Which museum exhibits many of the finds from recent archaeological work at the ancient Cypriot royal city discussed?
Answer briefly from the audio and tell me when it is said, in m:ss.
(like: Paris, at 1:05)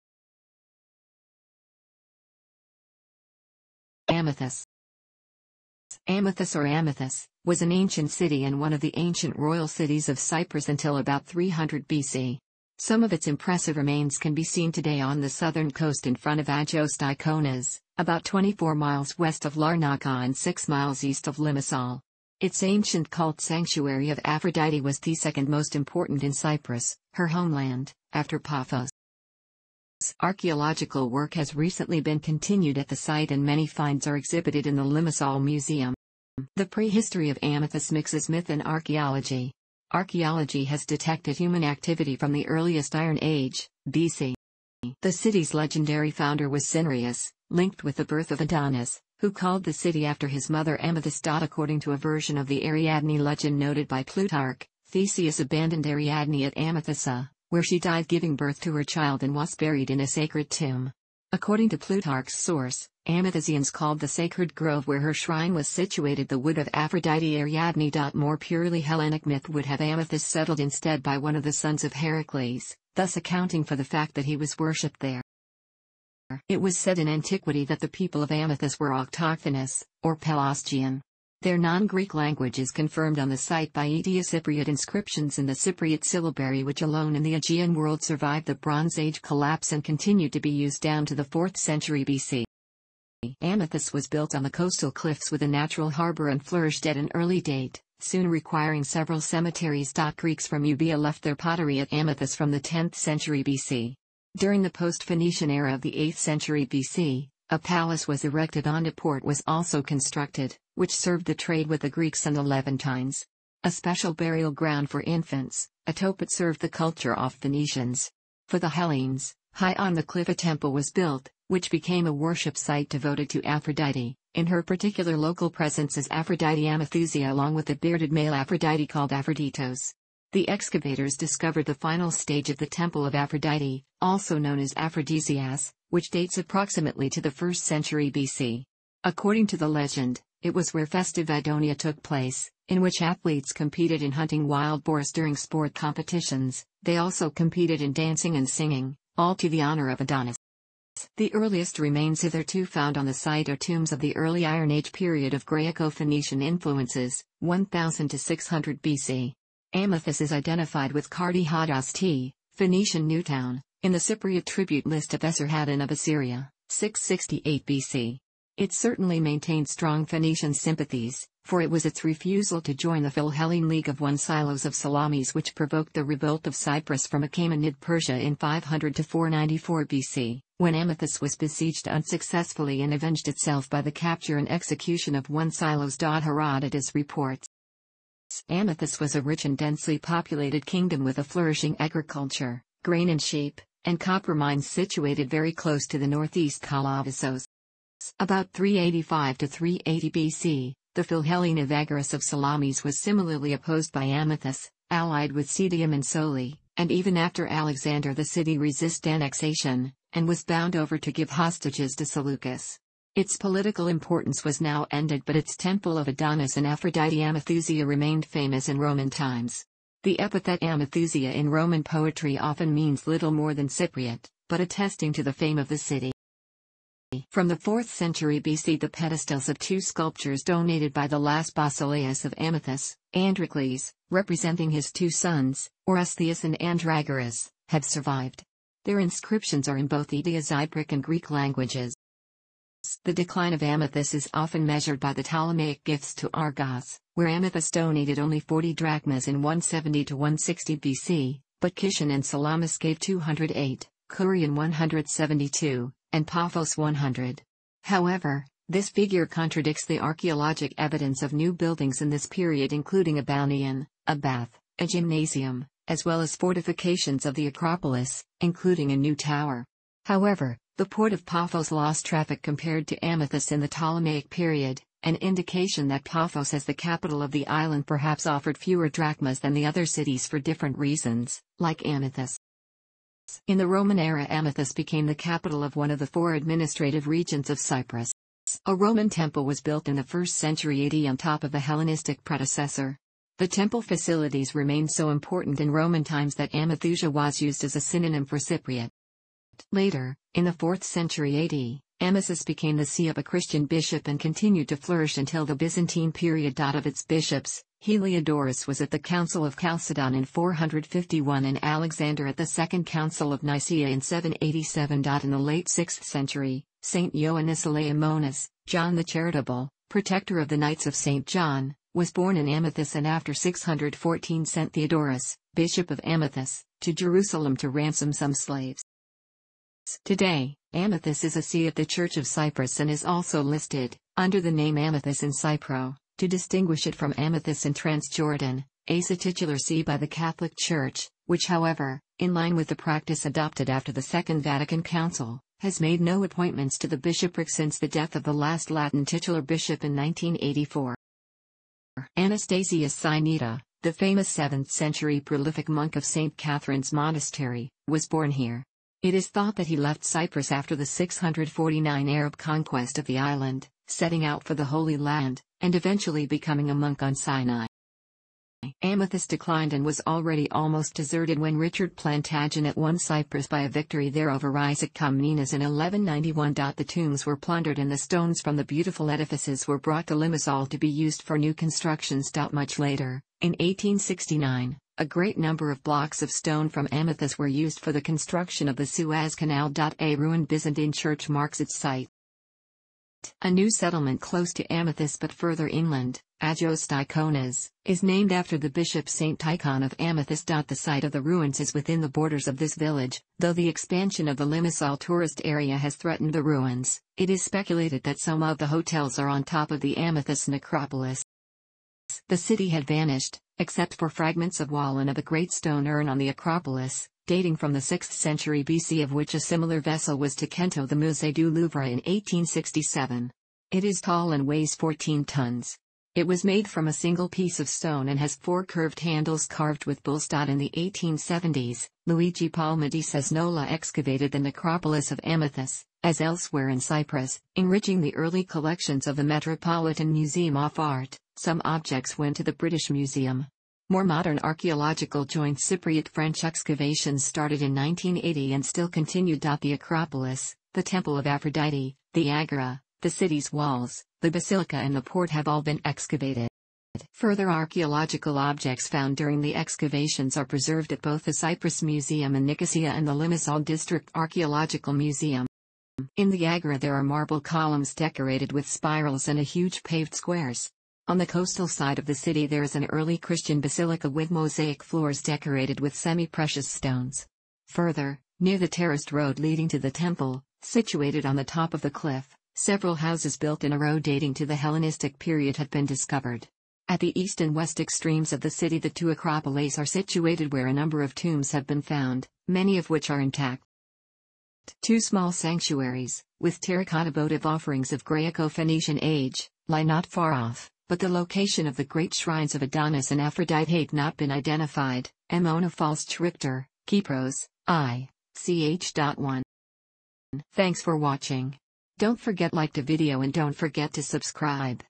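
Limassol Museum, at 0:34.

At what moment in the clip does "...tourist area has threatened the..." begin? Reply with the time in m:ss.
6:44.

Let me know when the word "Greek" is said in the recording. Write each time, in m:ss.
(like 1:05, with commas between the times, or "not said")
1:21, 1:40, 1:51, 4:01.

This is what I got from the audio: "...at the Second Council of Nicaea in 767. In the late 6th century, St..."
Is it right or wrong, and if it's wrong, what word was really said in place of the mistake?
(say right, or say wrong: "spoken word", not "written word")
wrong: "787", not "767".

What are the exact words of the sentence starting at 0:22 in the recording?
Its ancient cult sanctuary of Aphrodite was the second most important in Cyprus, her homeland, after Paphos.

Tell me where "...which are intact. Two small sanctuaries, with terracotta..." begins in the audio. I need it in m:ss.
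8:12.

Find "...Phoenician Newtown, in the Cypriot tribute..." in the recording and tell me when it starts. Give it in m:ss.
2:42.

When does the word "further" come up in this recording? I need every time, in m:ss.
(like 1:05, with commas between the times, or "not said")
6:35, 7:37, 7:57.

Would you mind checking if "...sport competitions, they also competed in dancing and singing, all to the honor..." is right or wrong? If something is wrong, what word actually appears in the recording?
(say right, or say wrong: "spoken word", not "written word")
right.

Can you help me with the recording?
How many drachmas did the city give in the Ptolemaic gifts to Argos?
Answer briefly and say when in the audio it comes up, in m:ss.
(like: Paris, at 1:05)
40, at 4:08.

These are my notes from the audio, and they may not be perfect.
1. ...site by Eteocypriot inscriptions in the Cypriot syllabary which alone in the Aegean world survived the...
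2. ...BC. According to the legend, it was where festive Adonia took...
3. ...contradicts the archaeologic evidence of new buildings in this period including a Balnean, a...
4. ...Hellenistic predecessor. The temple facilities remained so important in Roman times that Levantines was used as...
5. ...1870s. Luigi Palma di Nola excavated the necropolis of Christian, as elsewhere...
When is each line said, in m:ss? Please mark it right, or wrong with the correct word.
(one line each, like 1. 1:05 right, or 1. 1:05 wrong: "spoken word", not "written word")
1. 1:23 right
2. 2:18 right
3. 4:19 right
4. 4:51 wrong: "Amathusia", not "Levantines"
5. 7:10 wrong: "Amathus", not "Christian".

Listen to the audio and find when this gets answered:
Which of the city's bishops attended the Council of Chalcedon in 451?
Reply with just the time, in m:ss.
5:07.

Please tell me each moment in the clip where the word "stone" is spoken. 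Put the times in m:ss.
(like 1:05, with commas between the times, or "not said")
6:17, 6:26, 6:55, 7:07, 7:56.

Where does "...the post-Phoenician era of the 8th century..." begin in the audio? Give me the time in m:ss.
1:44.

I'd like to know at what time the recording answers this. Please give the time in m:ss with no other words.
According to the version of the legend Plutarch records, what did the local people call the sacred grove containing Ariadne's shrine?
1:06.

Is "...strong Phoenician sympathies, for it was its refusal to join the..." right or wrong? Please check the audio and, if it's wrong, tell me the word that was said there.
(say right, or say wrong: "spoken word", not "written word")
right.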